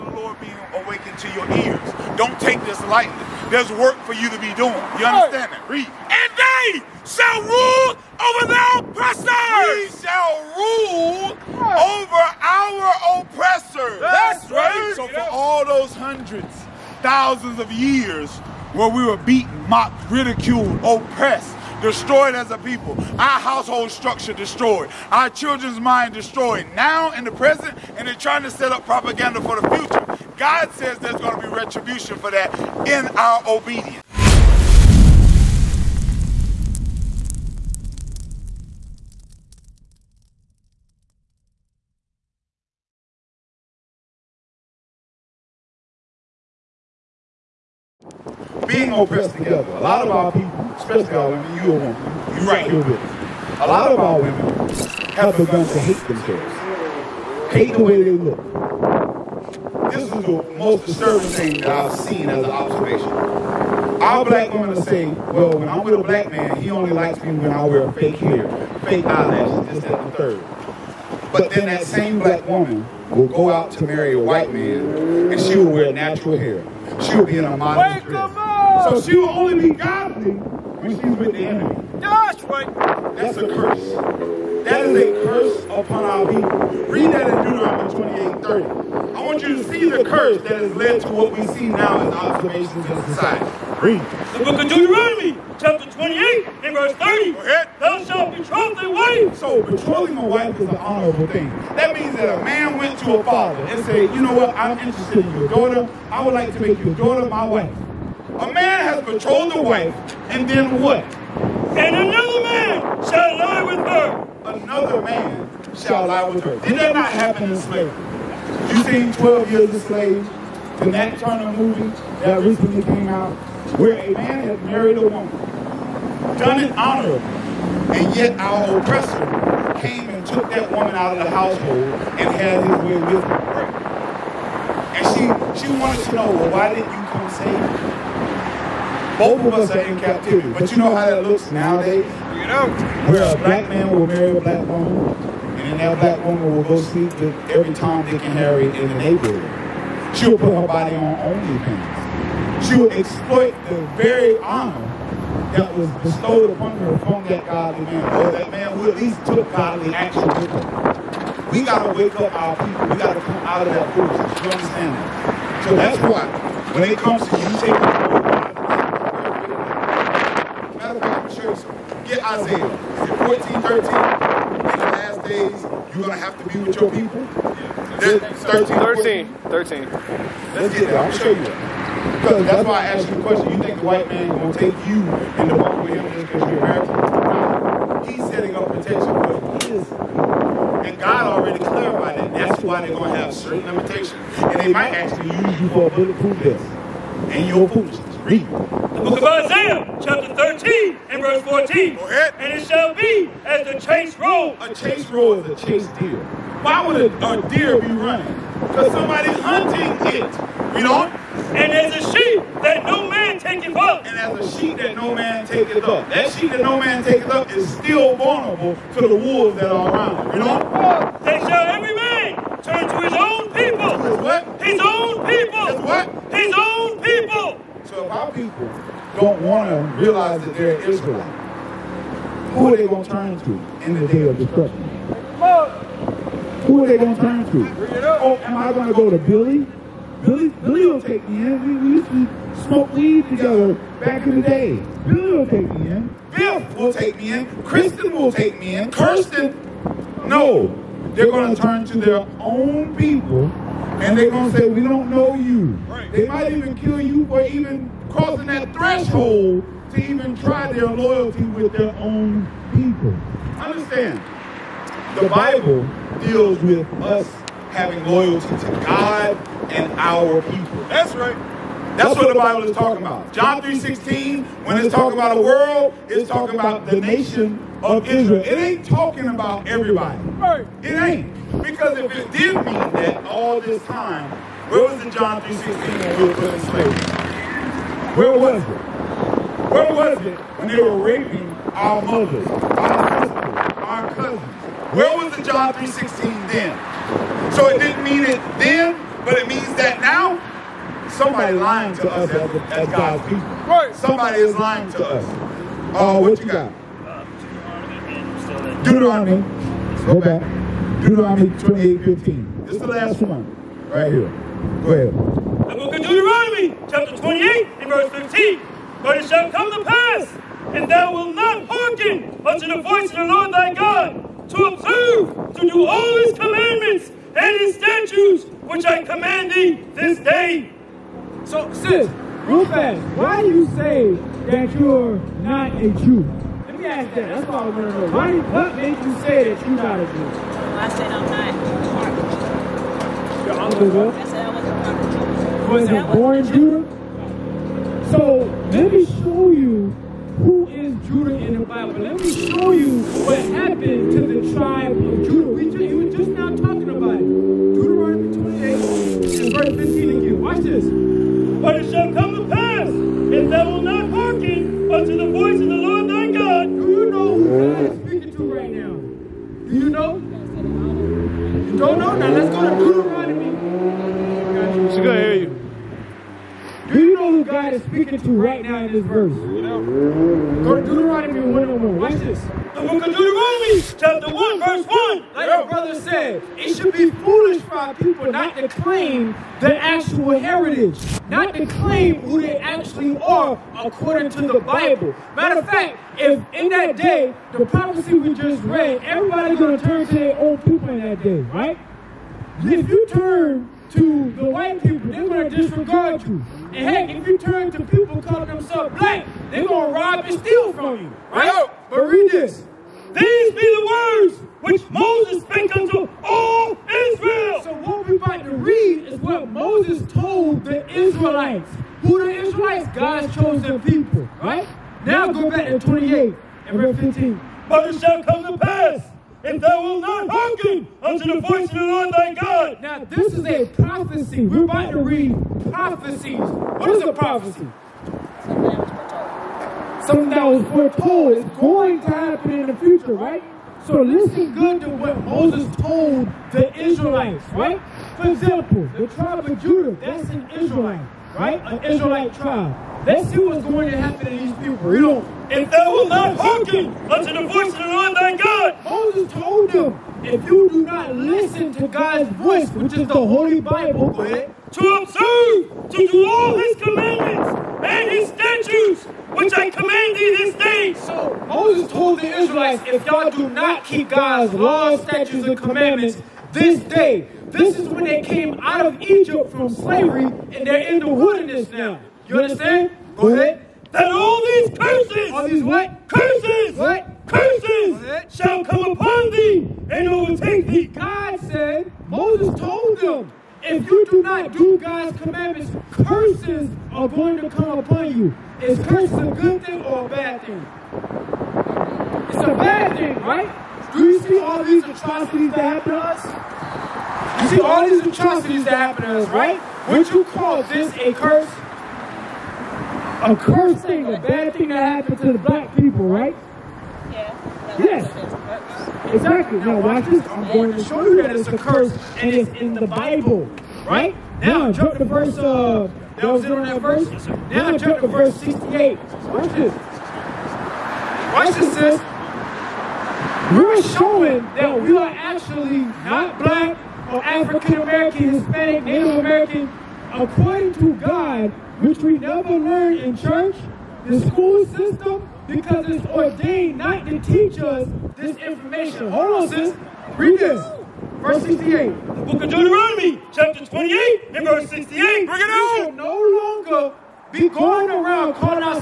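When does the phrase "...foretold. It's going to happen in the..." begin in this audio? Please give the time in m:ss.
7:20.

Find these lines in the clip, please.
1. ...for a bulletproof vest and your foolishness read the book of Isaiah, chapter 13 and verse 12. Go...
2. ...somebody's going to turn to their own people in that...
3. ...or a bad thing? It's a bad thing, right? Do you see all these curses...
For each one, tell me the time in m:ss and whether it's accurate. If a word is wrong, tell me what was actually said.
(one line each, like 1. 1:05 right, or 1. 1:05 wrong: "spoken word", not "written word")
1. 3:15 wrong: "14", not "12"
2. 6:39 wrong: "everybody", not "somebody"
3. 8:19 wrong: "atrocities", not "curses".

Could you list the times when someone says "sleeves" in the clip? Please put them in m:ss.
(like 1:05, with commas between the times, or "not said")
not said.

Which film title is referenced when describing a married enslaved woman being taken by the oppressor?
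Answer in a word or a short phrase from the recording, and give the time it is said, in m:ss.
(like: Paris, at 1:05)
12 Years a Slave, at 1:59.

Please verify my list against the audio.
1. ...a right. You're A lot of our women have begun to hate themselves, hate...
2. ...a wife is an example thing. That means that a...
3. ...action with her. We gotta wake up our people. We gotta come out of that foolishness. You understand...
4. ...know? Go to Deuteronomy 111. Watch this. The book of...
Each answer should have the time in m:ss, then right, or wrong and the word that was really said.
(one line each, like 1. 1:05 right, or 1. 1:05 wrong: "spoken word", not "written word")
1. 0:51 right
2. 1:40 wrong: "honorable", not "example"
3. 2:39 right
4. 6:19 wrong: "101", not "111".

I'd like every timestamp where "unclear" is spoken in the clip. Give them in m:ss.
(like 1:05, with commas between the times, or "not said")
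not said.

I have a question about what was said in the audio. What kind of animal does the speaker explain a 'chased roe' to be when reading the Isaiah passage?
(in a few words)
A deer.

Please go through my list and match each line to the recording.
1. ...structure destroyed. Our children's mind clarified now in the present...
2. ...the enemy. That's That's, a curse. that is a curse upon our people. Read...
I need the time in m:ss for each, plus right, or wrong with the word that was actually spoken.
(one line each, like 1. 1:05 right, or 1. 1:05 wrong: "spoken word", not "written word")
1. 0:23 wrong: "destroyed", not "clarified"
2. 1:21 right.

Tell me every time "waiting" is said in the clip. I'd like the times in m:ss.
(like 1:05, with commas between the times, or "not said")
not said.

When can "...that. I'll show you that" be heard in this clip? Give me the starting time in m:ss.
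2:59.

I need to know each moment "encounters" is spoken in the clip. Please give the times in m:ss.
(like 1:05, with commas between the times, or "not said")
not said.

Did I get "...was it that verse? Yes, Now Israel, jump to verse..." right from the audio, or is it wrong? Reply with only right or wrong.
wrong.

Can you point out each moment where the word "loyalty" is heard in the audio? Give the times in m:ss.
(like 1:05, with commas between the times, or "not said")
4:20, 4:28.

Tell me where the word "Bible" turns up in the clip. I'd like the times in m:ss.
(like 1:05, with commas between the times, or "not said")
4:25, 4:32, 5:51, 6:34, 7:43, 8:42.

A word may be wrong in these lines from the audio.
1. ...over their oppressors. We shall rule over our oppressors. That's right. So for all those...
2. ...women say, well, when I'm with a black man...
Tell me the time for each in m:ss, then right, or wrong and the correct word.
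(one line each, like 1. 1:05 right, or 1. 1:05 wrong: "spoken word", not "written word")
1. 0:08 right
2. 1:04 right.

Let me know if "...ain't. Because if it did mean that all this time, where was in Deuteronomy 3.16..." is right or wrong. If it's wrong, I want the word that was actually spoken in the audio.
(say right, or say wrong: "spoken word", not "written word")
wrong: "John", not "Deuteronomy".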